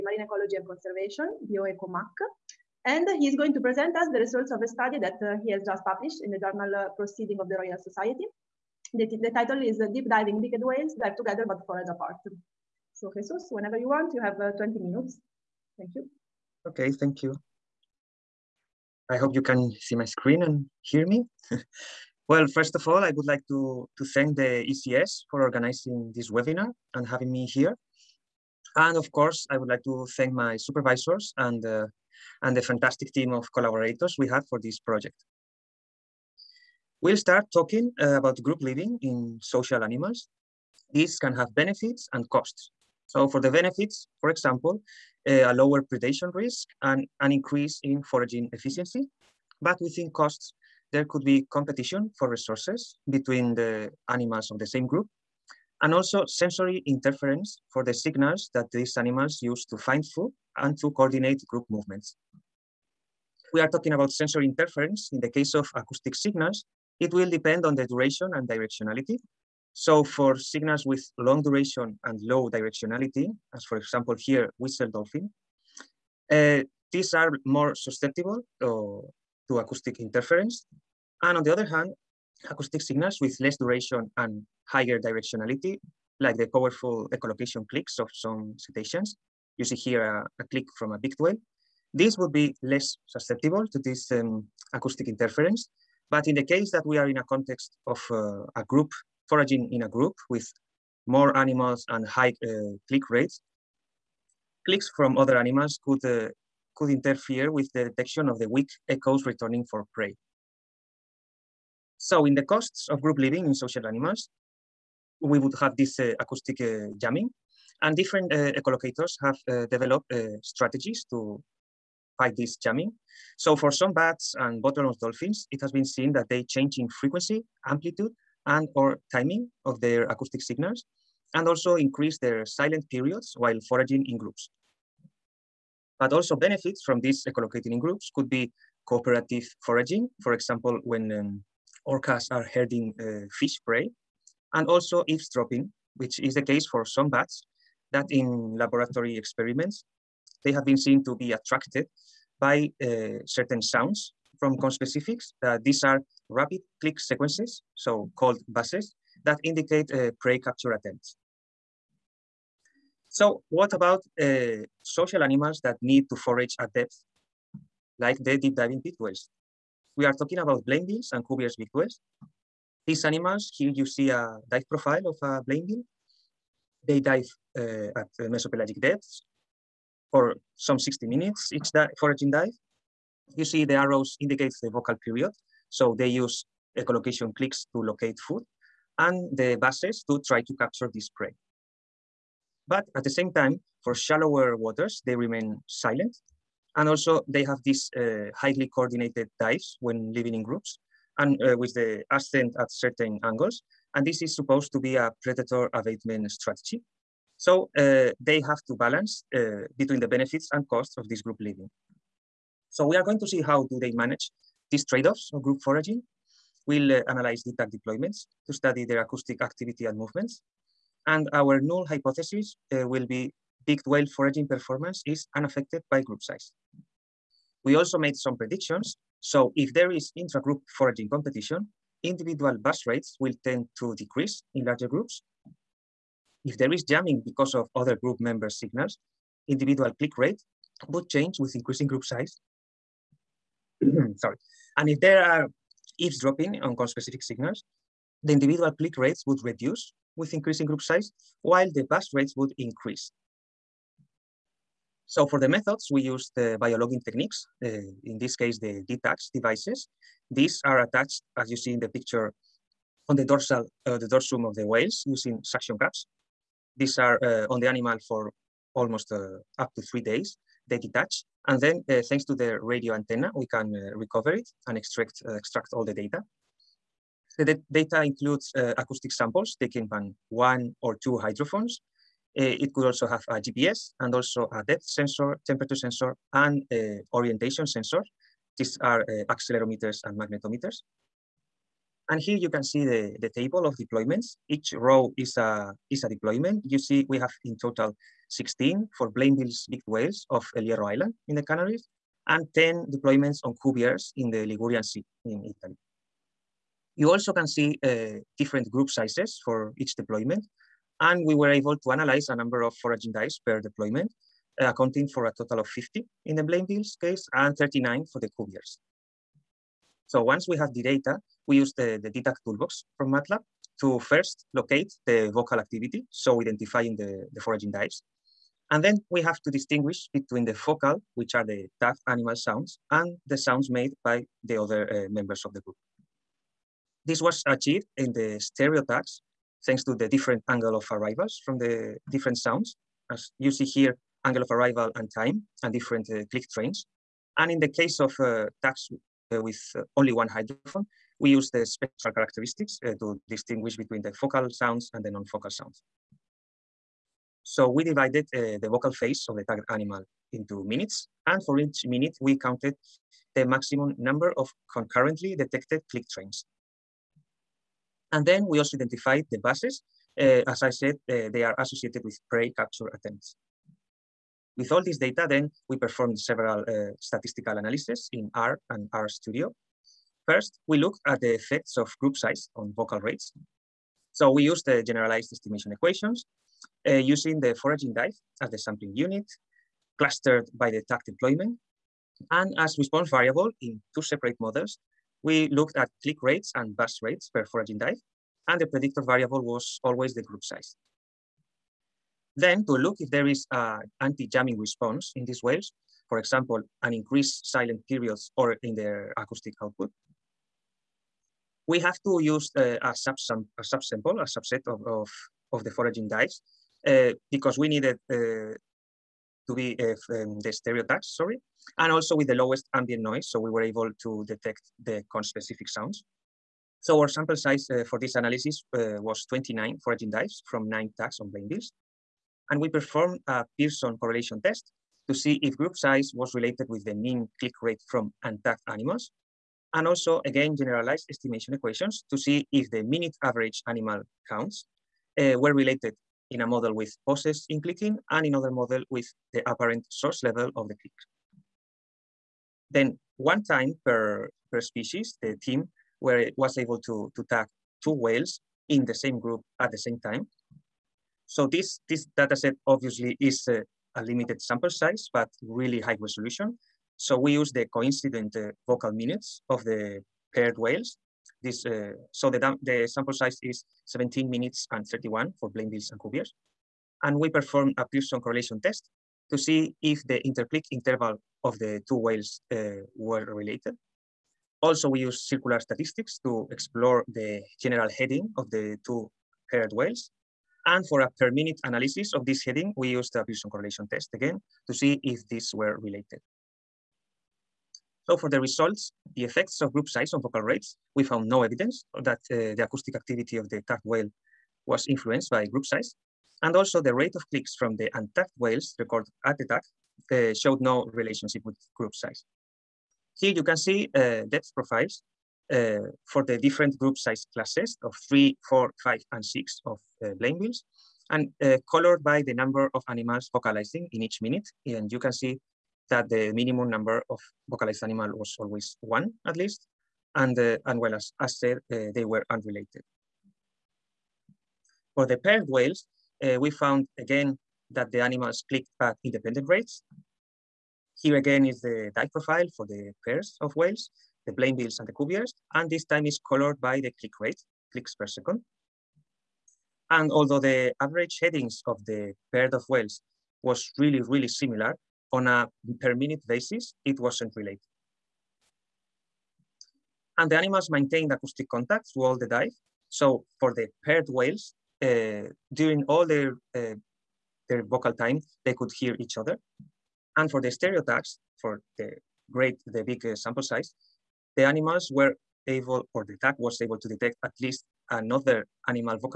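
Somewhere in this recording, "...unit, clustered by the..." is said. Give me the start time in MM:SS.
06:28.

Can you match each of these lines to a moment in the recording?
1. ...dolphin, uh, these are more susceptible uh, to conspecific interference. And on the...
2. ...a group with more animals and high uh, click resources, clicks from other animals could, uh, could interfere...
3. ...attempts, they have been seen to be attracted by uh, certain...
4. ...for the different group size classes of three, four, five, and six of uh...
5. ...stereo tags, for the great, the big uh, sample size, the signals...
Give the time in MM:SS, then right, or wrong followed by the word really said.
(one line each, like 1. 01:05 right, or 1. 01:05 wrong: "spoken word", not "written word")
1. 01:14 wrong: "acoustic", not "conspecific"
2. 01:39 wrong: "rates", not "resources"
3. 02:29 wrong: "experiments", not "attempts"
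4. 08:36 right
5. 09:30 wrong: "animals", not "signals".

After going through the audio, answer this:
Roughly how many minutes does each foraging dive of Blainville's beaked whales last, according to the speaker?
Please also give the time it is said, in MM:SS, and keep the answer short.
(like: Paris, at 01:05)
60, at 03:00.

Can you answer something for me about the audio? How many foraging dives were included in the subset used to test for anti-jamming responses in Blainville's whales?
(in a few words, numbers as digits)
29.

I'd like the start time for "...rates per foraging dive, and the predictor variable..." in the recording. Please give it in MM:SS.
06:37.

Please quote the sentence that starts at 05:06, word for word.
You also can see uh, different group sizes for each deployment.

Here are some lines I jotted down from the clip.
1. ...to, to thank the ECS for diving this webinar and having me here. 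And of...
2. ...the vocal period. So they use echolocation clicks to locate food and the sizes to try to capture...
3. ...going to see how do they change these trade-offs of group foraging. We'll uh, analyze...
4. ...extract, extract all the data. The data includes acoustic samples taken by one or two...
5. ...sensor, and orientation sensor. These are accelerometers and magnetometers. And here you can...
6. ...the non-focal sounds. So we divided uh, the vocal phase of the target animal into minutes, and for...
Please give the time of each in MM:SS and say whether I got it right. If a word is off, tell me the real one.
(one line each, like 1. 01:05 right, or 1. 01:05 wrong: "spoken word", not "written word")
1. 00:23 wrong: "organizing", not "diving"
2. 03:04 wrong: "buzzes", not "sizes"
3. 03:33 wrong: "manage", not "change"
4. 04:34 right
5. 04:45 right
6. 05:55 right.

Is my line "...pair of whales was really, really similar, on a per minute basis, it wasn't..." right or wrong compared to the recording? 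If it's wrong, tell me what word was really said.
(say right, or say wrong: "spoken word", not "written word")
right.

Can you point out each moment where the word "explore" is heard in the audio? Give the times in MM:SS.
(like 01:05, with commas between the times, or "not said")
08:06.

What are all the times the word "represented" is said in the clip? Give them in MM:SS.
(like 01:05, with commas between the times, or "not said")
not said.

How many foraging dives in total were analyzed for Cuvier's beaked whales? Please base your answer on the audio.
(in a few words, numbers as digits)
39.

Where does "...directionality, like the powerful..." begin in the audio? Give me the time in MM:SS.
01:24.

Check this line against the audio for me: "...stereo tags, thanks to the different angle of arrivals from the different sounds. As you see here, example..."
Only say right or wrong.
wrong.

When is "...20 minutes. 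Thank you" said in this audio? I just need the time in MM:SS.
00:14.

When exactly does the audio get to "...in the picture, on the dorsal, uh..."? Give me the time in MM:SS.
04:21.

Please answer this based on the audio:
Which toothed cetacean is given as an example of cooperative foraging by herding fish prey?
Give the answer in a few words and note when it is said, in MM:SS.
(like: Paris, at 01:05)
Orcas, at 02:21.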